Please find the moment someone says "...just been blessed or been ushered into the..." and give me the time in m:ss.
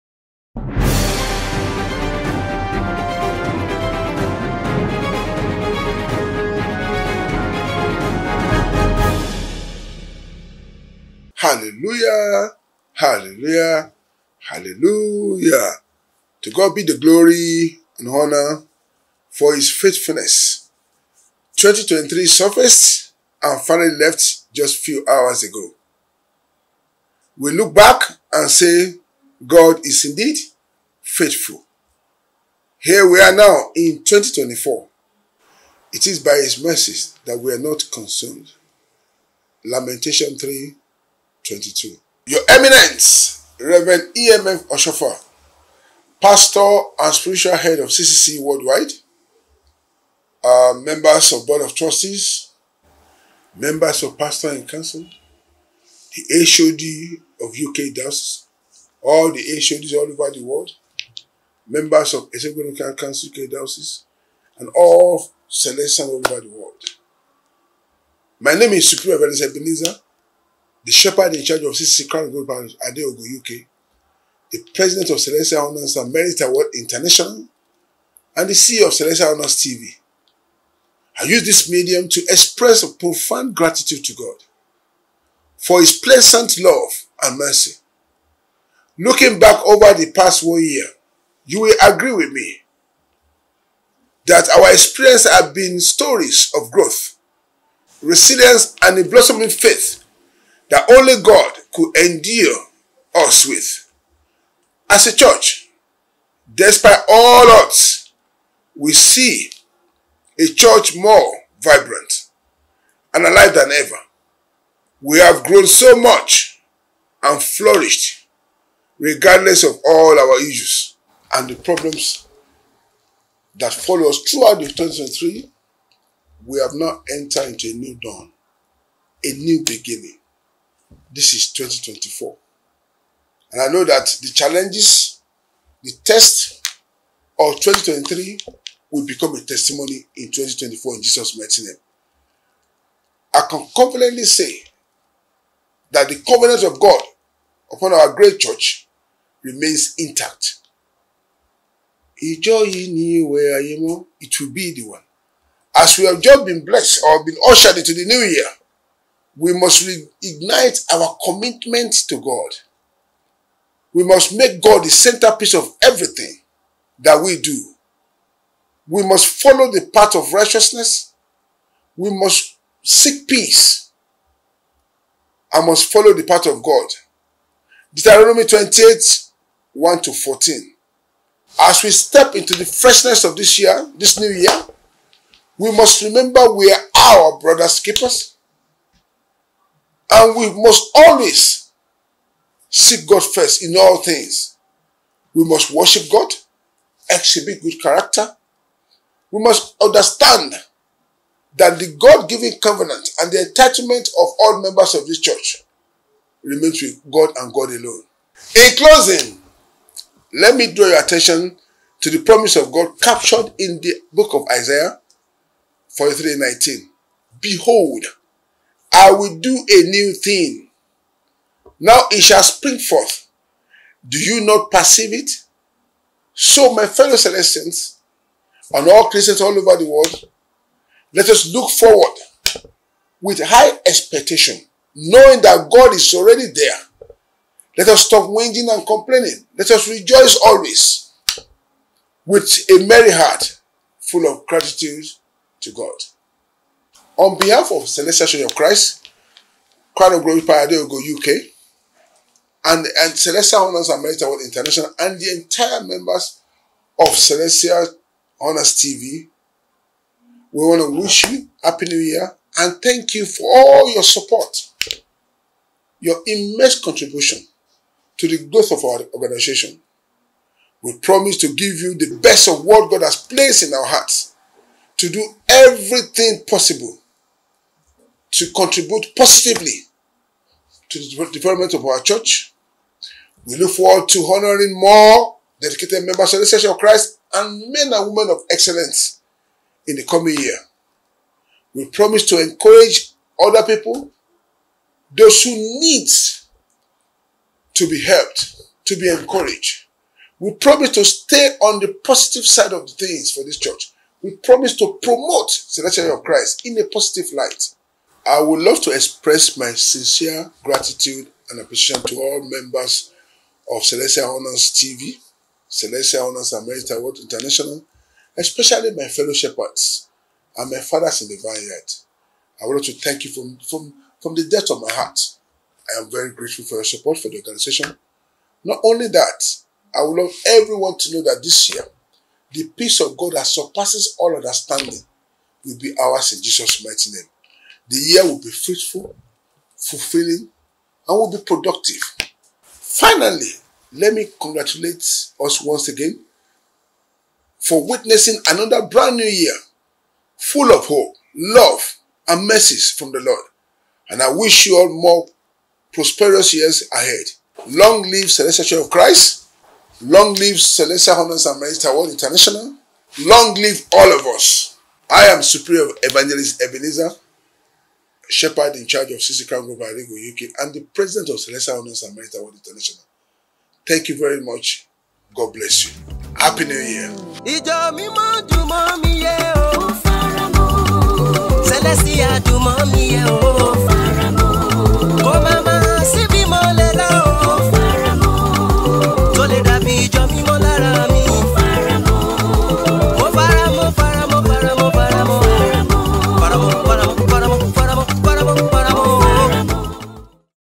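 2:36.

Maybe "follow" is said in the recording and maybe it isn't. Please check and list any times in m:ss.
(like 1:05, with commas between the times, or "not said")
2:03, 2:49, 2:55.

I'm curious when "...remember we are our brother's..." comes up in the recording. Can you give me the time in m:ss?
3:06.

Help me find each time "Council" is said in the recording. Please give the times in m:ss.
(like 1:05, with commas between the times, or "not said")
0:54, 1:02.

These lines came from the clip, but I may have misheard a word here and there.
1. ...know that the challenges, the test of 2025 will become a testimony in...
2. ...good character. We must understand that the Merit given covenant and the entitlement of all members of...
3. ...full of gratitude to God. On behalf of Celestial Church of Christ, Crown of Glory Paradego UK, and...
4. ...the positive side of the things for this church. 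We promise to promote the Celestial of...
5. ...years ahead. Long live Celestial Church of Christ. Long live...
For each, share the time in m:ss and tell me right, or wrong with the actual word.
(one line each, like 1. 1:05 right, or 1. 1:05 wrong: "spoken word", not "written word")
1. 2:13 wrong: "2023", not "2025"
2. 3:17 wrong: "God", not "Merit"
3. 4:03 right
4. 5:01 wrong: "Church", not "Celestial"
5. 5:56 right.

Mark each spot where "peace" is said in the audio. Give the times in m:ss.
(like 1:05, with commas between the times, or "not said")
2:53, 5:32.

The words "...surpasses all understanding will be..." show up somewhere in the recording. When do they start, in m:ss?
5:33.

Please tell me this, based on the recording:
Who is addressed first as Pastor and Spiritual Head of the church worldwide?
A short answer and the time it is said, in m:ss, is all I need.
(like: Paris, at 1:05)
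Reverend EMF Oshoffa, at 0:43.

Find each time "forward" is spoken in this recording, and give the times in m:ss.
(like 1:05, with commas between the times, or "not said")
3:51, 4:43.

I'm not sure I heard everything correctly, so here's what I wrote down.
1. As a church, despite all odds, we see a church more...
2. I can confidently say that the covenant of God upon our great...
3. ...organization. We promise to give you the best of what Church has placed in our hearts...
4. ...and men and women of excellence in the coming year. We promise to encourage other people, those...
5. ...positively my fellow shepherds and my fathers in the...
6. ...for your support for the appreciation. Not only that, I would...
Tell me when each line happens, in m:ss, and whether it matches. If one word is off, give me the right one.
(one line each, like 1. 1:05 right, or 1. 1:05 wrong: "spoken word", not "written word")
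1. 1:44 right
2. 2:23 right
3. 4:29 wrong: "God", not "Church"
4. 4:47 right
5. 5:18 wrong: "especially", not "positively"
6. 5:26 wrong: "organization", not "appreciation".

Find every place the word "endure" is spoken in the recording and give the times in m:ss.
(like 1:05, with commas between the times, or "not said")
1:41.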